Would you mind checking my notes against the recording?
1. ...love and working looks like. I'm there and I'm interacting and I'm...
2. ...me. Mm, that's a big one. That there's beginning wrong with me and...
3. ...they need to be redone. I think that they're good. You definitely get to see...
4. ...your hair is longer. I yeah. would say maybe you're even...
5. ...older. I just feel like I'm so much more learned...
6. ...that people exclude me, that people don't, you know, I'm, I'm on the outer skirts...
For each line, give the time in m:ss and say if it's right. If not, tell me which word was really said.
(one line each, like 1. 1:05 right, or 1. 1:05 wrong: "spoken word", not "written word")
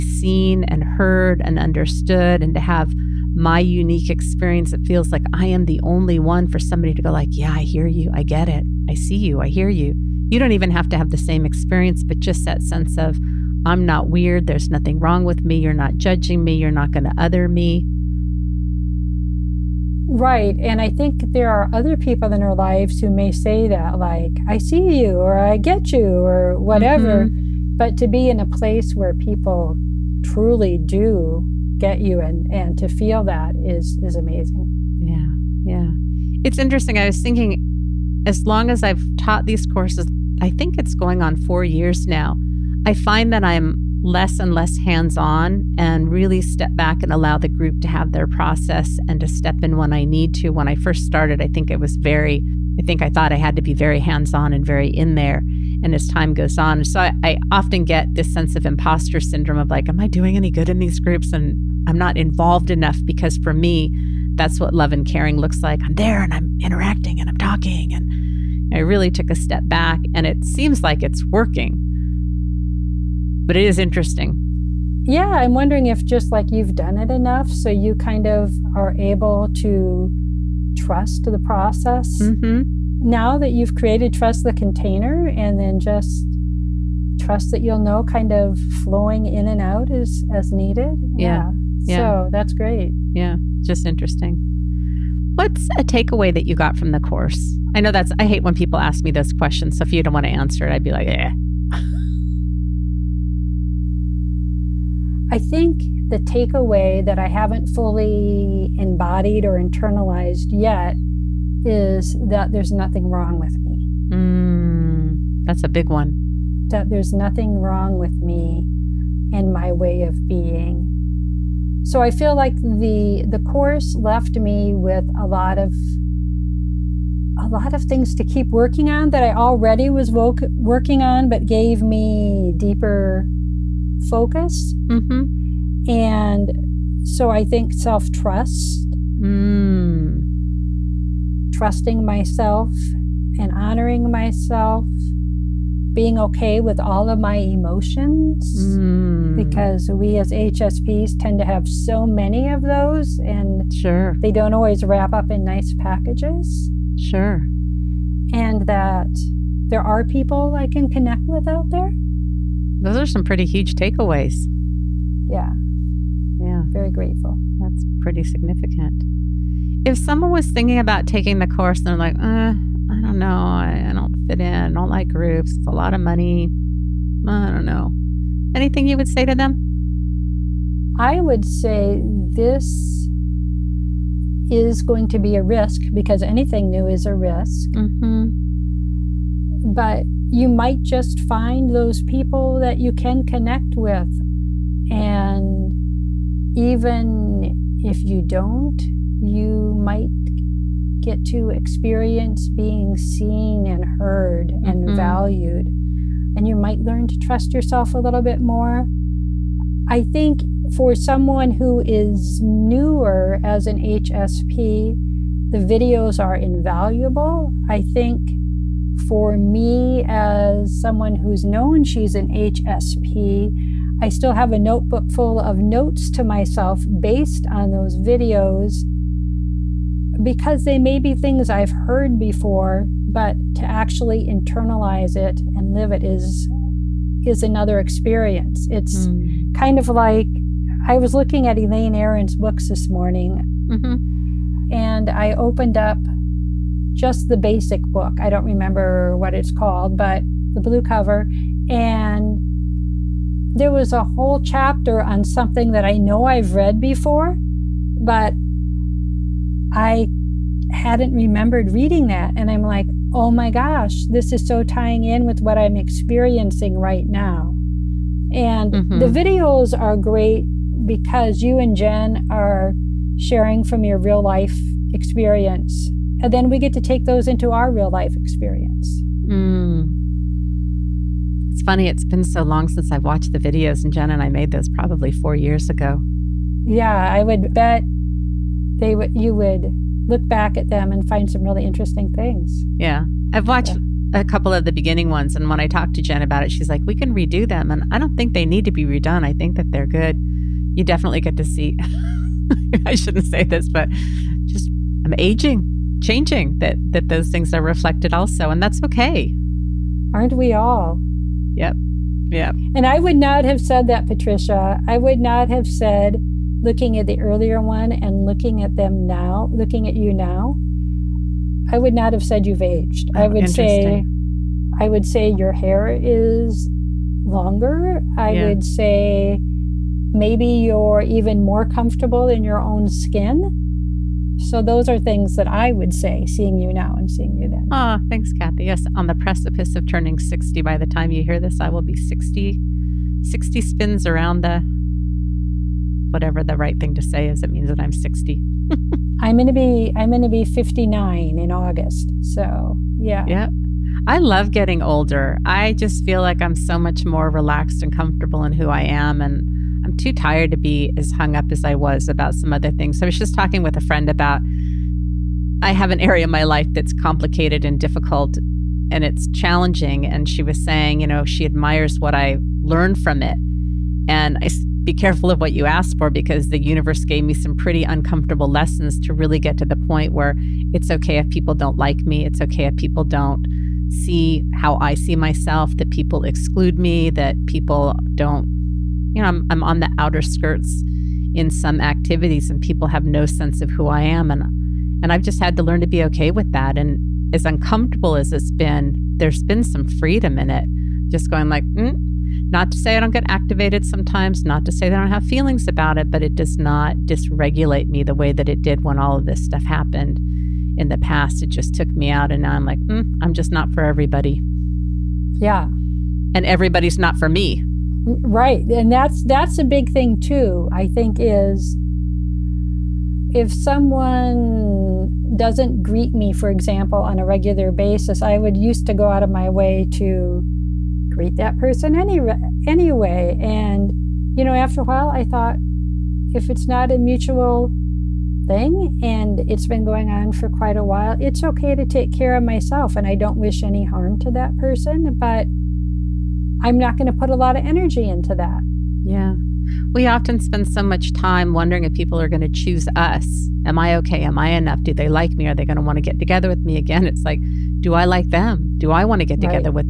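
1. 1:04 wrong: "caring", not "working"
2. 1:53 wrong: "nothing", not "beginning"
3. 4:58 right
4. 5:25 right
5. 5:54 wrong: "relaxed", not "learned"
6. 6:25 right.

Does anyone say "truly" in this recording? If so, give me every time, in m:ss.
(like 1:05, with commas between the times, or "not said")
0:30.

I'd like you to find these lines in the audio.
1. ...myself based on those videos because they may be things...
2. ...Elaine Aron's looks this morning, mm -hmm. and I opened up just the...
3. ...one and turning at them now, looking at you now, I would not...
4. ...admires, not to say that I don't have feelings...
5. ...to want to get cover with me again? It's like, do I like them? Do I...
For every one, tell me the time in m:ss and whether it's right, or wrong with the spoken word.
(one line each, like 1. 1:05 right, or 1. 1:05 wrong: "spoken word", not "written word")
1. 3:46 right
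2. 4:01 wrong: "books", not "looks"
3. 5:17 wrong: "looking", not "turning"
4. 6:43 wrong: "sometimes", not "admires"
5. 7:35 wrong: "together", not "cover".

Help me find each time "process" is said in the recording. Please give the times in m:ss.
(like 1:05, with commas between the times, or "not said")
0:48, 1:21.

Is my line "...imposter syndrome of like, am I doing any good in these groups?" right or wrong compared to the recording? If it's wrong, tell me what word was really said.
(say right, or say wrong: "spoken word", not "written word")
right.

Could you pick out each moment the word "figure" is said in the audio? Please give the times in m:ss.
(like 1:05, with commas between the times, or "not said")
not said.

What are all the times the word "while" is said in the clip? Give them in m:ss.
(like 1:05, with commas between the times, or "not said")
7:14, 7:20.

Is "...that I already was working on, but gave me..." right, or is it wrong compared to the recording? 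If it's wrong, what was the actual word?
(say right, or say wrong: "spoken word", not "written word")
right.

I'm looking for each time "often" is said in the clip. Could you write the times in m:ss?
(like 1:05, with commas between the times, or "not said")
0:57, 7:30.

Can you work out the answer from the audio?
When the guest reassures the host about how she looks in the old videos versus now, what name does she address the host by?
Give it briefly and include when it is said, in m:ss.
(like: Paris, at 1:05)
Patricia, at 5:14.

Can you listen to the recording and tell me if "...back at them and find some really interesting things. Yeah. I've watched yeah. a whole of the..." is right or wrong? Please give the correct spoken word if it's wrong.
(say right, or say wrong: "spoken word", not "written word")
wrong: "couple", not "whole".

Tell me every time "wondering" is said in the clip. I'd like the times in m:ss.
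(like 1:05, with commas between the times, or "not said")
1:15, 7:31.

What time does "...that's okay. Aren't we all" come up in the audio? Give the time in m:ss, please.
5:08.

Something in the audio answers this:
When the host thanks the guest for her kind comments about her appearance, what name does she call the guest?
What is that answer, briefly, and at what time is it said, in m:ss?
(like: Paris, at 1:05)
Kathy, at 5:38.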